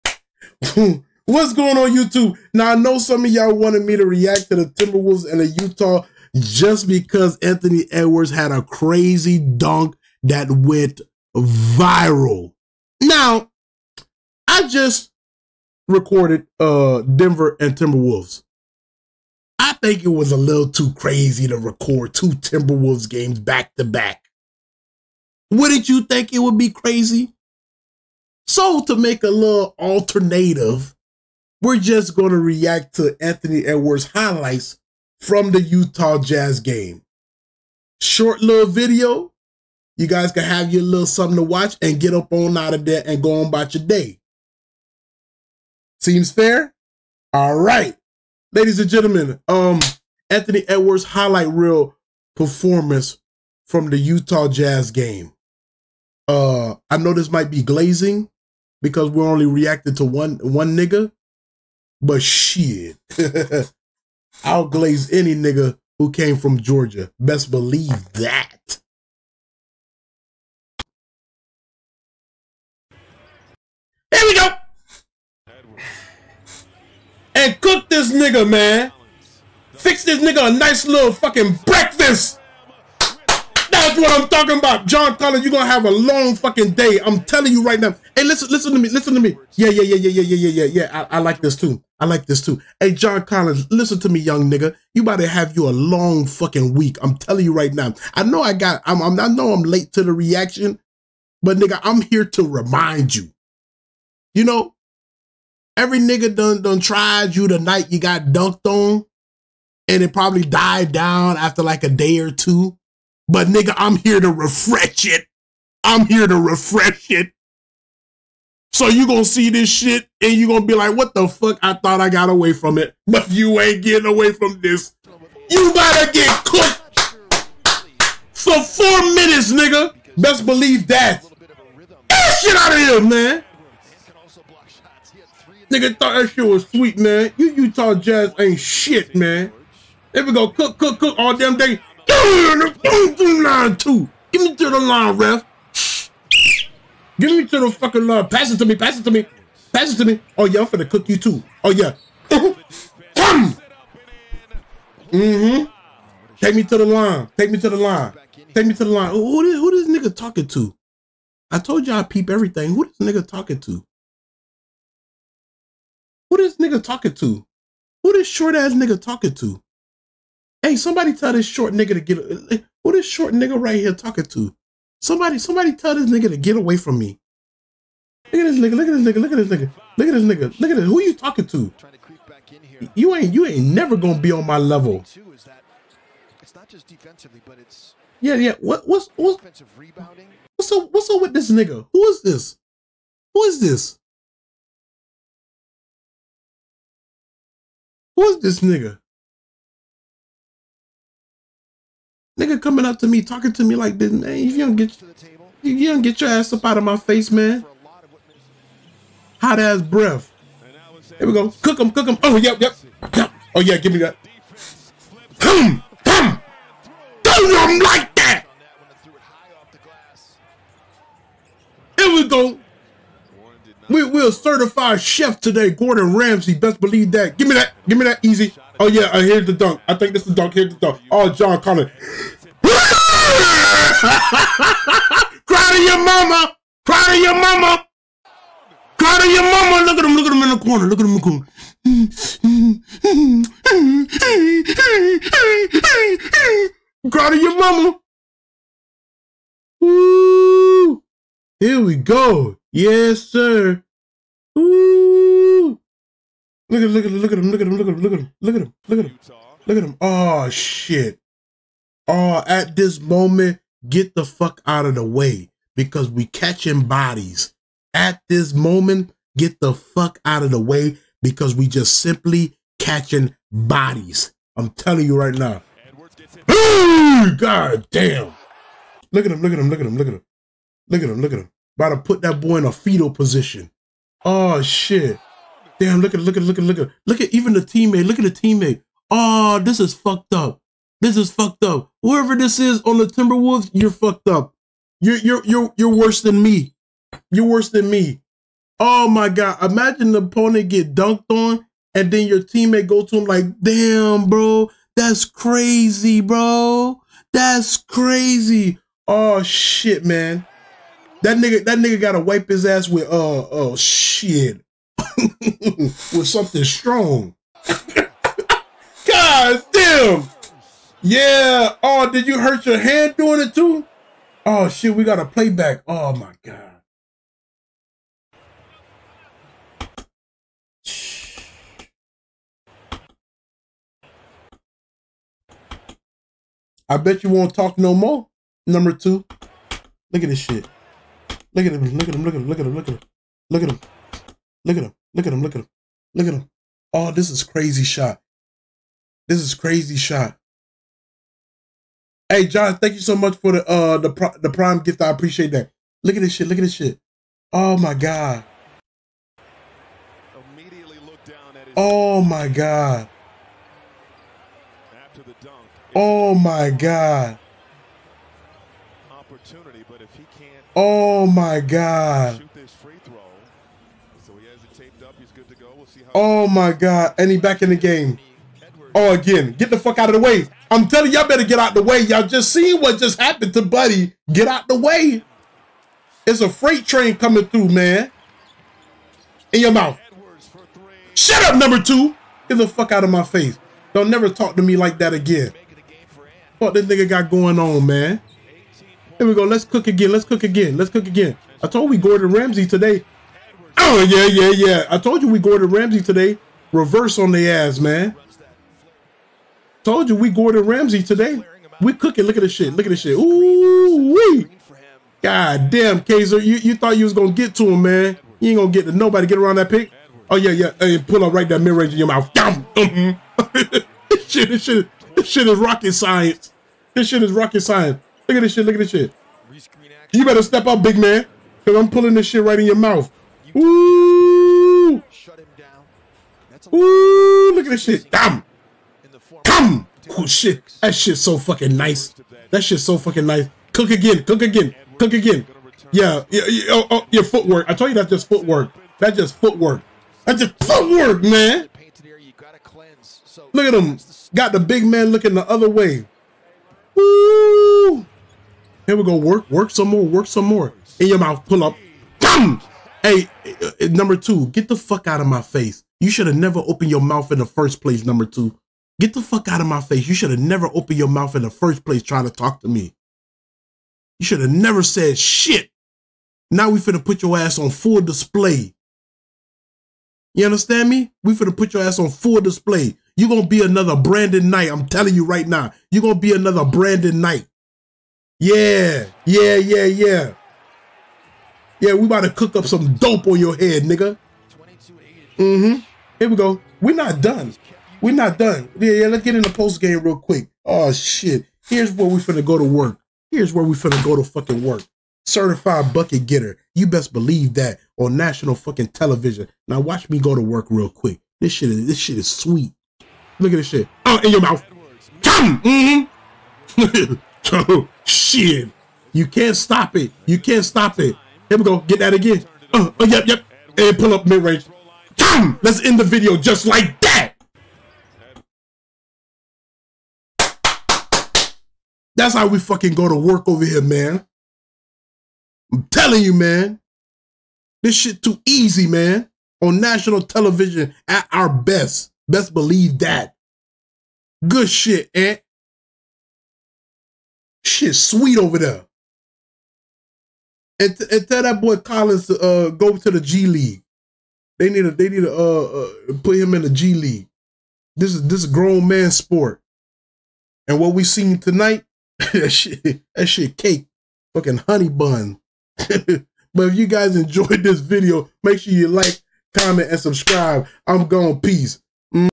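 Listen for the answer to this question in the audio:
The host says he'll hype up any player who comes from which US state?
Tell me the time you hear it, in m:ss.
1:06.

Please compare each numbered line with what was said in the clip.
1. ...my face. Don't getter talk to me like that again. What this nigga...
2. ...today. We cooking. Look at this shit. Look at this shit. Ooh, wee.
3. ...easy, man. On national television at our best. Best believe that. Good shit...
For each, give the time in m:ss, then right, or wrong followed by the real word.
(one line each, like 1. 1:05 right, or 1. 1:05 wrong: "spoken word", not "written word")
1. 6:33 wrong: "never", not "getter"
2. 6:51 right
3. 8:58 right.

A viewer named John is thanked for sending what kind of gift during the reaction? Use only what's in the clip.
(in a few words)
Prime gift.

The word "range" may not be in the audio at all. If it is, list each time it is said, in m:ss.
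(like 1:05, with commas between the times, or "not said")
7:01, 8:44.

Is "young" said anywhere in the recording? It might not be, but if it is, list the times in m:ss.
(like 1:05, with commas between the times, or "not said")
1:34.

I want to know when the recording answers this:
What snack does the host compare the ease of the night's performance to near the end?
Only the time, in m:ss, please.
9:24.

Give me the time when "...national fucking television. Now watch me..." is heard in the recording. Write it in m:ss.
8:28.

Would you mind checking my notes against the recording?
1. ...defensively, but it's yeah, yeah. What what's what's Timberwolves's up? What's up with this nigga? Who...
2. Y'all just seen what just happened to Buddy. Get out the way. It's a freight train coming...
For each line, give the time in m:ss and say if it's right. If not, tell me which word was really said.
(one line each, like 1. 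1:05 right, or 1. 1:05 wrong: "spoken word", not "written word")
1. 3:06 wrong: "What", not "Timberwolves"
2. 6:22 right.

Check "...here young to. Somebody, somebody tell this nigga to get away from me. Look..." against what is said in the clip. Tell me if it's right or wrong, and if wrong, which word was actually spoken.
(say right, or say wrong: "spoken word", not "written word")
wrong: "talking", not "young".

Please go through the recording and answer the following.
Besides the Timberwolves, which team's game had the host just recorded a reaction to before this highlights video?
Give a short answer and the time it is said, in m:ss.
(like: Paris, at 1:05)
Denver, at 0:17.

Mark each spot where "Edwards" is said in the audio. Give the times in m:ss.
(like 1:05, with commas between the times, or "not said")
0:07, 0:33, 0:50.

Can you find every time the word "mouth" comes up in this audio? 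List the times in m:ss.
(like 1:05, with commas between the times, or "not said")
6:29, 7:02, 7:12, 7:41, 7:46, 7:51, 8:34.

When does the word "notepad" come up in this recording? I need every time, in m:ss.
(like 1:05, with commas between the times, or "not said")
not said.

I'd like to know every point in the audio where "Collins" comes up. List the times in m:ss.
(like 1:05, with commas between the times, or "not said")
1:25, 1:33, 9:11.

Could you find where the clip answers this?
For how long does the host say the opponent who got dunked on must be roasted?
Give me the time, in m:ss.
2:08.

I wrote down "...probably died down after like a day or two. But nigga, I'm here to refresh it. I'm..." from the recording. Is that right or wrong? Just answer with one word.
right.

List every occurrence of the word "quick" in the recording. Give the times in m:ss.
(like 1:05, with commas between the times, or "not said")
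8:20, 8:30.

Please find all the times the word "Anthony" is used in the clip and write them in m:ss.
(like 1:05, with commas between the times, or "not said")
0:07, 0:33, 0:50.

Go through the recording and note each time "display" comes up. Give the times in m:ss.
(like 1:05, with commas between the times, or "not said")
7:58, 8:02.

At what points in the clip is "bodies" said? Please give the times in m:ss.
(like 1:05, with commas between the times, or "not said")
4:26, 4:33.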